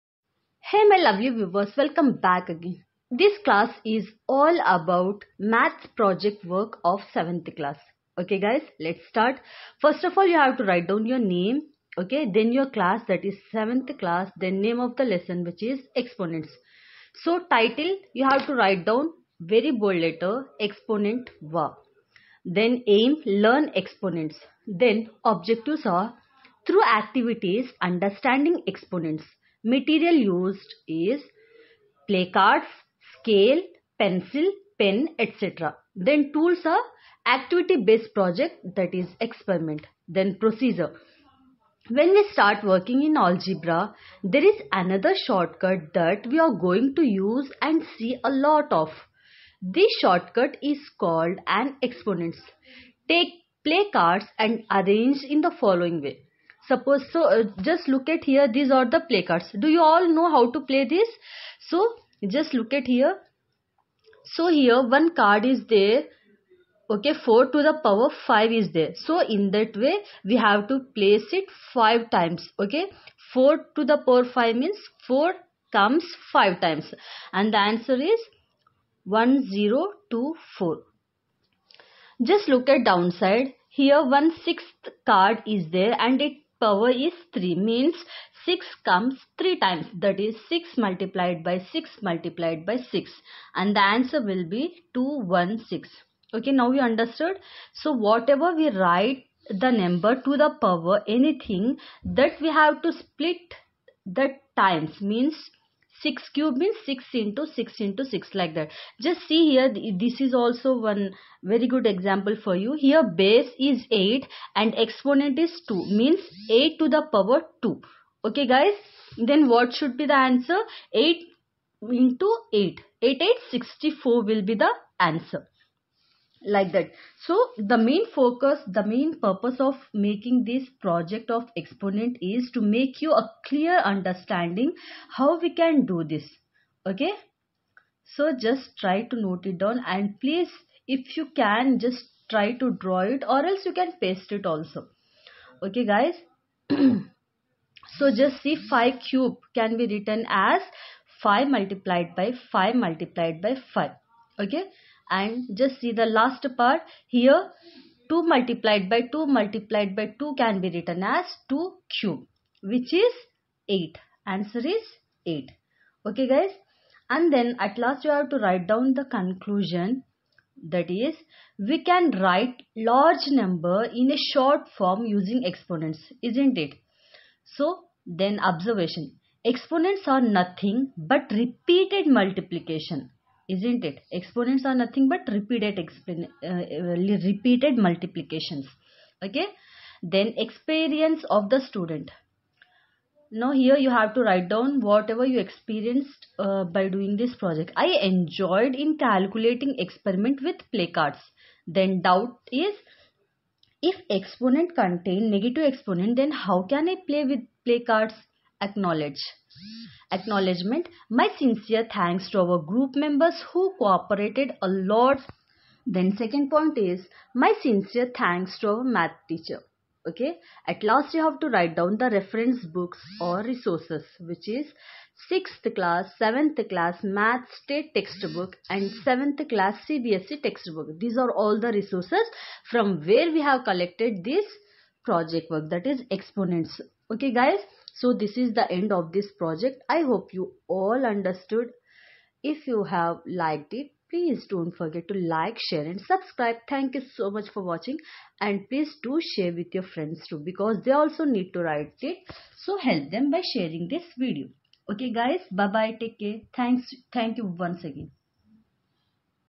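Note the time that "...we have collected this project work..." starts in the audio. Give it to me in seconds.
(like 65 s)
233 s.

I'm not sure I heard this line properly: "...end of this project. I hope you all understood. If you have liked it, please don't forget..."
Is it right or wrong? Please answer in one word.
right.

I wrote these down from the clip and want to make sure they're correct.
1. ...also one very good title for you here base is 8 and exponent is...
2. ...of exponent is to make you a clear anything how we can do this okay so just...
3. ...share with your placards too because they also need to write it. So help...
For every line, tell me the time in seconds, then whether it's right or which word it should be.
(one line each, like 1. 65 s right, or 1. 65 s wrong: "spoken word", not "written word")
1. 110 s wrong: "example", not "title"
2. 131 s wrong: "understanding", not "anything"
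3. 249 s wrong: "friends", not "placards".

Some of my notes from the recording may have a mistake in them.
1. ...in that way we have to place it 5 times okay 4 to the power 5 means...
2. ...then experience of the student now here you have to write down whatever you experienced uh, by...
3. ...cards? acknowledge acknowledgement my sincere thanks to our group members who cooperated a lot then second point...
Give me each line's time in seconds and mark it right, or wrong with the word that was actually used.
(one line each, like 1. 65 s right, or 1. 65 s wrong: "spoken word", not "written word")
1. 69 s right
2. 190 s right
3. 207 s right.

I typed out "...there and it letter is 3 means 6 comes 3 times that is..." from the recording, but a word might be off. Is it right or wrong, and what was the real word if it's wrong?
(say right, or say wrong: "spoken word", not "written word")
wrong: "power", not "letter".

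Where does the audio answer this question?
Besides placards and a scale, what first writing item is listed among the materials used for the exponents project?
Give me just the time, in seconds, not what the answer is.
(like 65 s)
33 s.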